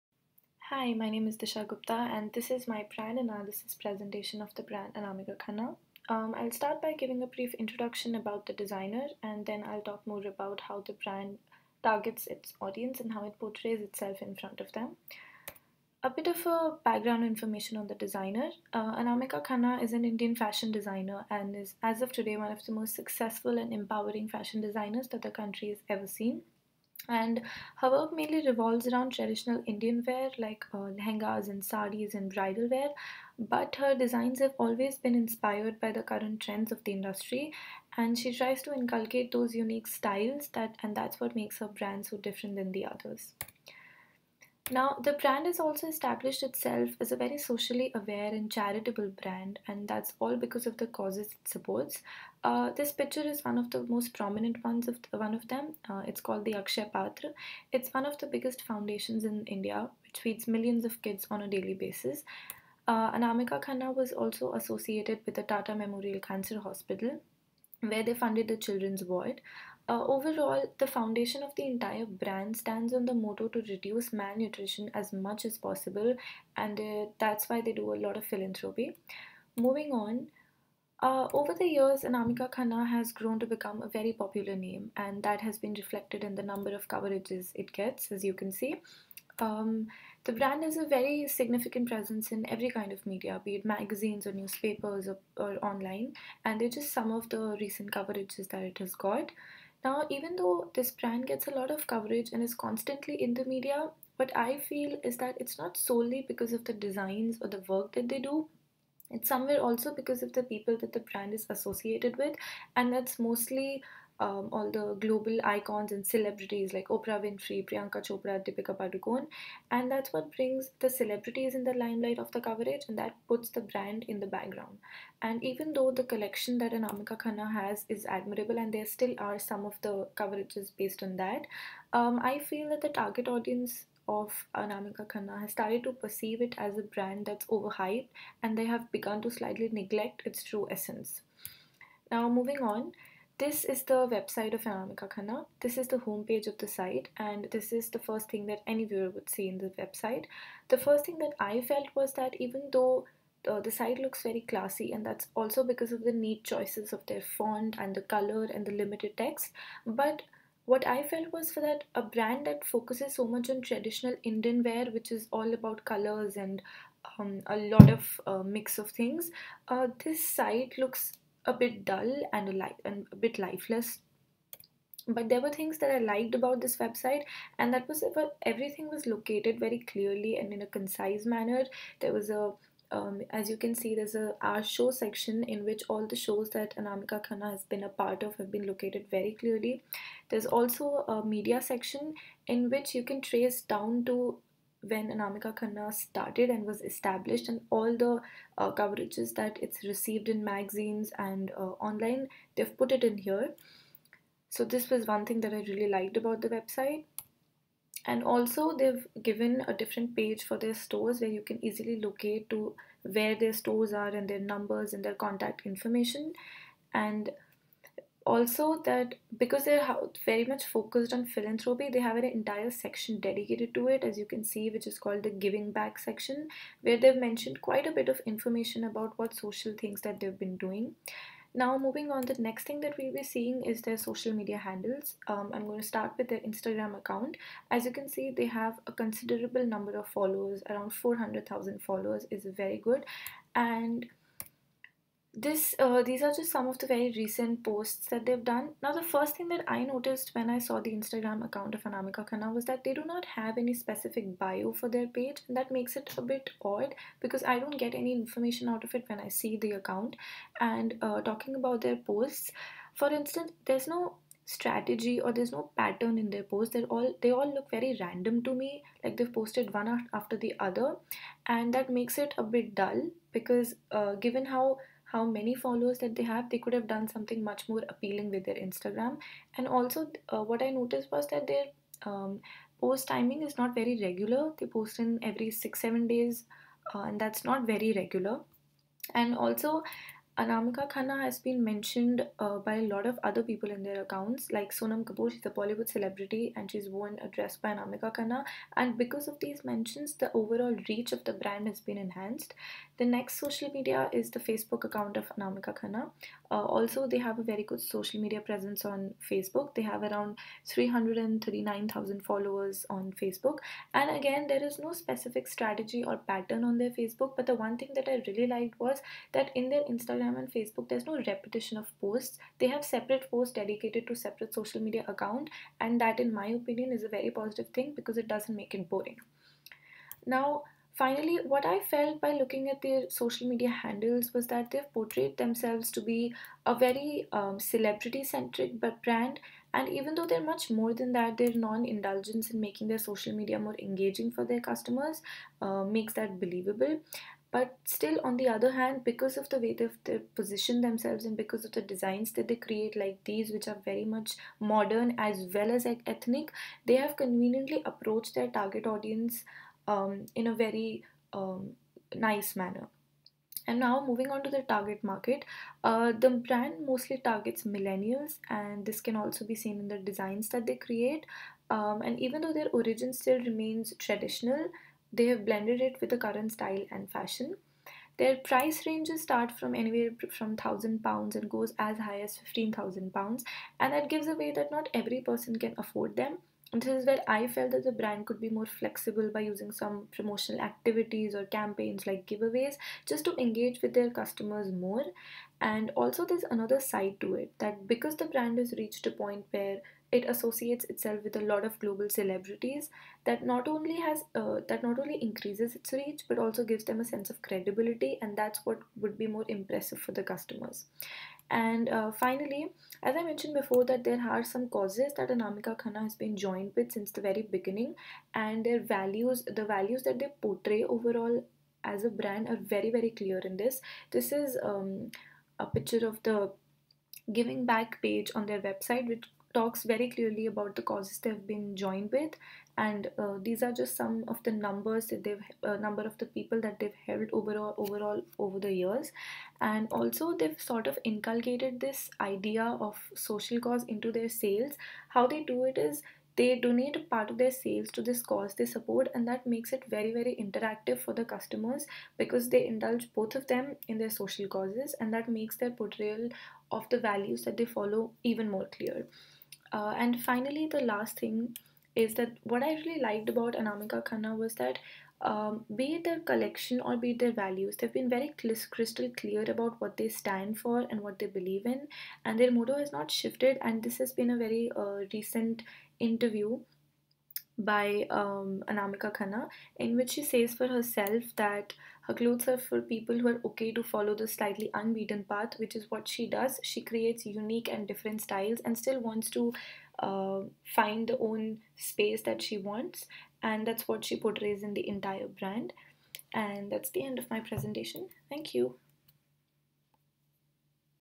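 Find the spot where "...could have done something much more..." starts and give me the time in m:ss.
4:36.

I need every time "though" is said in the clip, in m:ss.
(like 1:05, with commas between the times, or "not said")
1:40, 2:05, 2:32, 5:40, 6:12.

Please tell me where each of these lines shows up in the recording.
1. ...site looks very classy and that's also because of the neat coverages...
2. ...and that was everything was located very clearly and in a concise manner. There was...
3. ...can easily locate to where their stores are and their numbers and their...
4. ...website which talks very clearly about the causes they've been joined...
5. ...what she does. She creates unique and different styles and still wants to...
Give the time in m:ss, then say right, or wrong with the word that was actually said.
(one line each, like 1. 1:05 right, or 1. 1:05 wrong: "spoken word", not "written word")
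1. 2:33 wrong: "choices", not "coverages"
2. 2:57 right
3. 3:31 right
4. 7:08 right
5. 8:05 right.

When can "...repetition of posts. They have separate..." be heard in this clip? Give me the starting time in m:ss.
5:21.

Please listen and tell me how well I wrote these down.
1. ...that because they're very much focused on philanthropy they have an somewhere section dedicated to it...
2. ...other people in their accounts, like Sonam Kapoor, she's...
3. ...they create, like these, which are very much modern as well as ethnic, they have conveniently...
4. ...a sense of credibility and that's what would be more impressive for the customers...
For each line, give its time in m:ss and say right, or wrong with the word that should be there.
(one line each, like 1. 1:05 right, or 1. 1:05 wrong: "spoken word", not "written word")
1. 3:38 wrong: "entire", not "somewhere"
2. 4:53 right
3. 5:52 right
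4. 6:46 right.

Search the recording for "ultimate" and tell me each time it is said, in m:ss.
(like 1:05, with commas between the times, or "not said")
not said.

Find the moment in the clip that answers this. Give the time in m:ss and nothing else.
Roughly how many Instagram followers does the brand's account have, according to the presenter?
4:00.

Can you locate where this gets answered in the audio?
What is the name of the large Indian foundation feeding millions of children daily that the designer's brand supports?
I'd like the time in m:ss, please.
0:56.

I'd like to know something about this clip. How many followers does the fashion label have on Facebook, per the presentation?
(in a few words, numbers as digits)
339,000.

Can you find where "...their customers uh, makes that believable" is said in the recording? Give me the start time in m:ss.
5:44.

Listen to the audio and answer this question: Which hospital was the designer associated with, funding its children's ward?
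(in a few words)
Tata Memorial Cancer Hospital.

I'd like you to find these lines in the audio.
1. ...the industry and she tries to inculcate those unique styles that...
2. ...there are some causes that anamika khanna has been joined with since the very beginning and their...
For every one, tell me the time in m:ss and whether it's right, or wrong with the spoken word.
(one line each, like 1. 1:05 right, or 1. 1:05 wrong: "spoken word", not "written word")
1. 0:36 right
2. 6:54 right.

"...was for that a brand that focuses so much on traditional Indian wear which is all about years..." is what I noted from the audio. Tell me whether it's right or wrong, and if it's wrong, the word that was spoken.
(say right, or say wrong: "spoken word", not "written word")
wrong: "colors", not "years".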